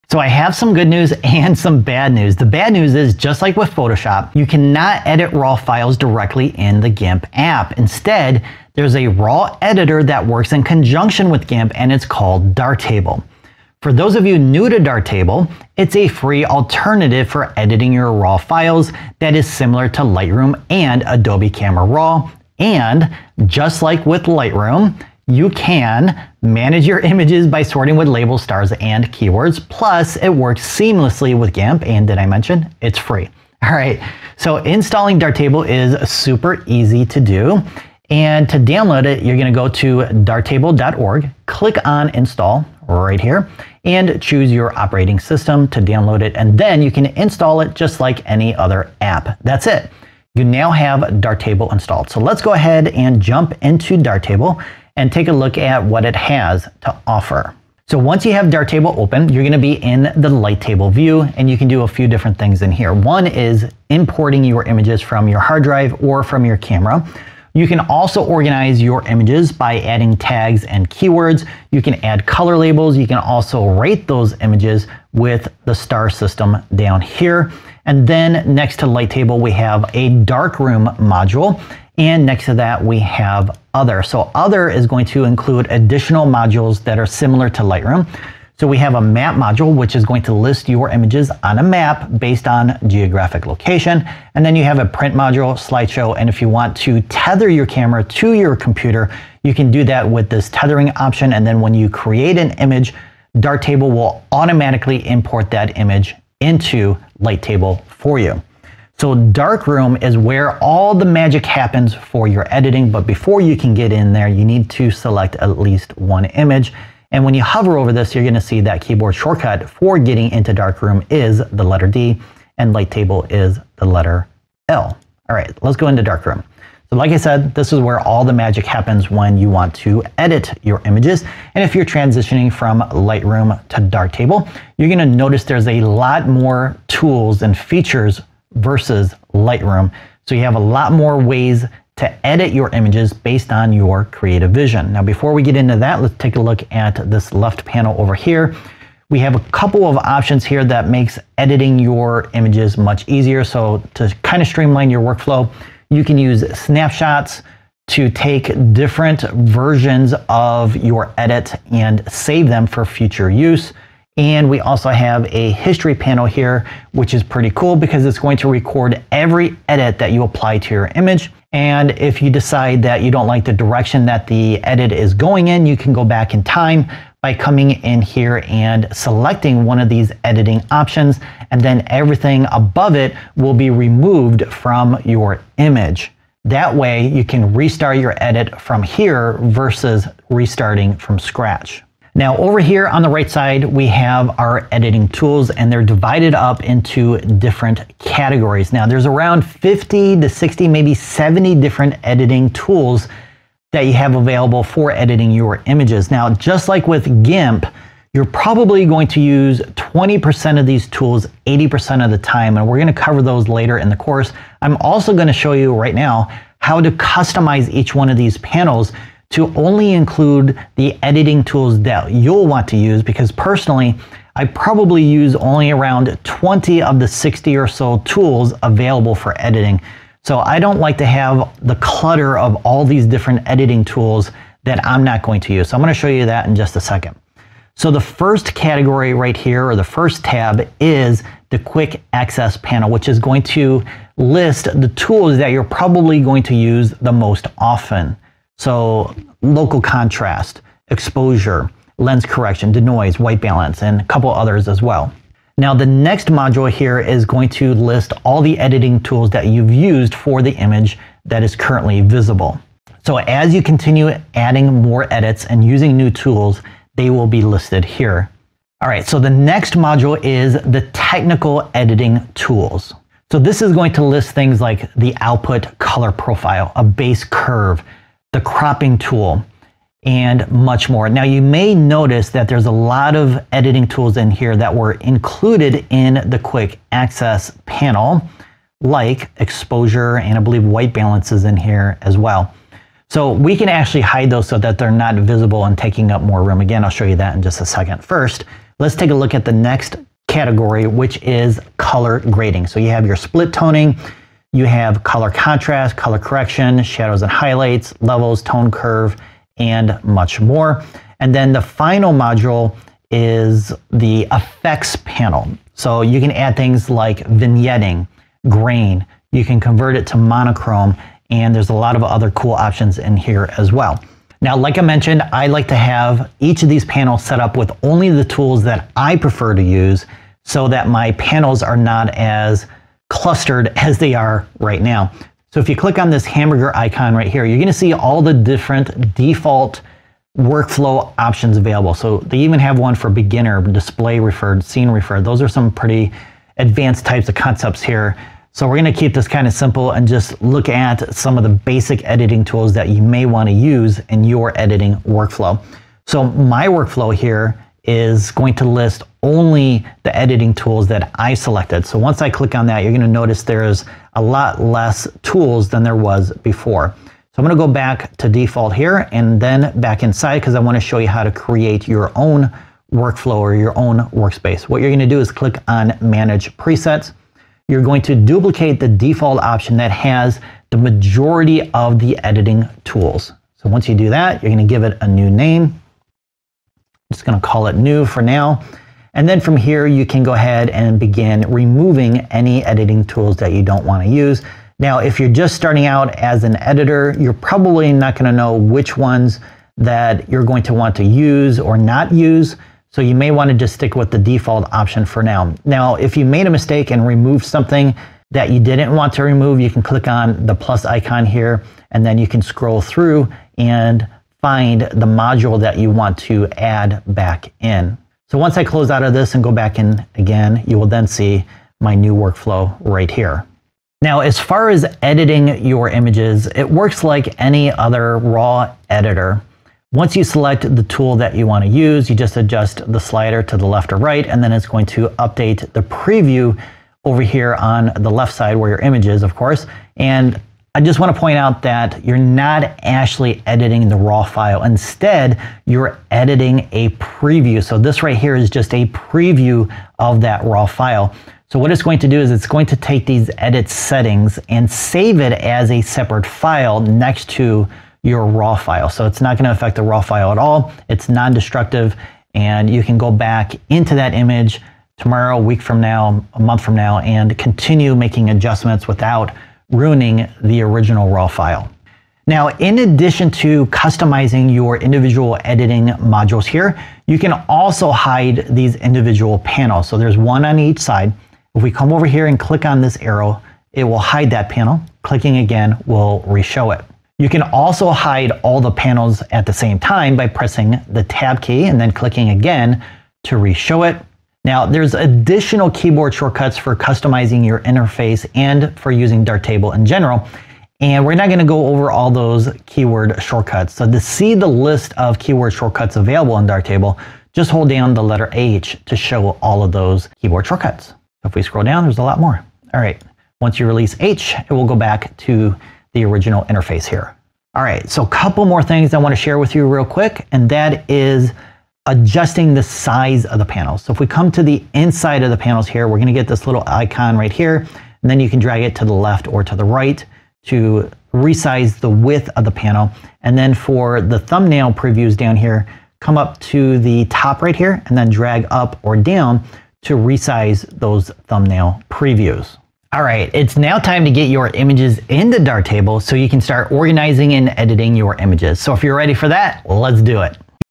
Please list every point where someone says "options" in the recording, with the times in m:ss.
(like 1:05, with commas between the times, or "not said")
1:40, 2:29, 3:00, 5:22, 5:41, 6:19, 6:44.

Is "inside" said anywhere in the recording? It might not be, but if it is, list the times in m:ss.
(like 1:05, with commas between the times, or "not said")
6:10, 8:44.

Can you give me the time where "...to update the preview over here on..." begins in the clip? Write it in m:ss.
7:14.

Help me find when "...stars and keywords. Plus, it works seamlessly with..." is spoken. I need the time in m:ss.
0:28.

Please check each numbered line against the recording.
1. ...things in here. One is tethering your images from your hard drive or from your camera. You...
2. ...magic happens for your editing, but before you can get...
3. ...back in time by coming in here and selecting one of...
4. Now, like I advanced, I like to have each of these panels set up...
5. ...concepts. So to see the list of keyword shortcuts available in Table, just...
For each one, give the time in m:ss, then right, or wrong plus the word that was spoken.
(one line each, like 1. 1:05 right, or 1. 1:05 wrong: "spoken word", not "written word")
1. 1:02 wrong: "importing", not "tethering"
2. 1:51 right
3. 2:56 right
4. 5:24 wrong: "mentioned", not "advanced"
5. 8:23 wrong: "shortcuts", not "concepts".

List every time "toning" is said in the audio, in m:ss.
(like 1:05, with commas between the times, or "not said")
5:03.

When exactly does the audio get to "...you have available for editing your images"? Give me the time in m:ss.
3:23.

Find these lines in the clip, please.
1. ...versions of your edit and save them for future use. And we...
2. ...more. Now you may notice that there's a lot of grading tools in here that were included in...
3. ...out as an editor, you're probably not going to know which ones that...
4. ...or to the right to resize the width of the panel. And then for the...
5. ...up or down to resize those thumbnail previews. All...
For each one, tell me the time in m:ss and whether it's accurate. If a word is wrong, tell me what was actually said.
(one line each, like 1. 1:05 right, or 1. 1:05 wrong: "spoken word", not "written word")
1. 2:39 right
2. 4:40 wrong: "editing", not "grading"
3. 6:35 right
4. 8:49 right
5. 8:58 right.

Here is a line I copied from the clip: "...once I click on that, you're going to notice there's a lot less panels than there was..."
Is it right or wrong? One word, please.
wrong.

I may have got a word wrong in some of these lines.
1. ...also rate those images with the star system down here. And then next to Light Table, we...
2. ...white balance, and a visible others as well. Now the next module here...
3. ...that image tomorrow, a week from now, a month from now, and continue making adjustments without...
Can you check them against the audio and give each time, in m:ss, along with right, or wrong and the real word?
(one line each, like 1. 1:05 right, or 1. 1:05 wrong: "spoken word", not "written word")
1. 1:13 right
2. 4:13 wrong: "couple", not "visible"
3. 7:43 right.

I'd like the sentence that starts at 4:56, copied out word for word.
Again, I'll show you that in just a second.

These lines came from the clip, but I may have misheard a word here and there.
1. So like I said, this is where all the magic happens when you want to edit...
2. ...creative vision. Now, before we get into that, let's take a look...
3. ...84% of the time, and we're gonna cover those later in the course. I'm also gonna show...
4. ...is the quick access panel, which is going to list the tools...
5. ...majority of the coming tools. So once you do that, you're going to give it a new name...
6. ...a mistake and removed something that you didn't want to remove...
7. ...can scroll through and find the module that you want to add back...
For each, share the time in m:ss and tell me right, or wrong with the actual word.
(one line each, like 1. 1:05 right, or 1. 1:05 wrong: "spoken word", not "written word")
1. 2:06 right
2. 2:24 right
3. 3:31 wrong: "80", not "84"
4. 4:00 right
5. 6:20 wrong: "editing", not "coming"
6. 6:46 right
7. 6:52 right.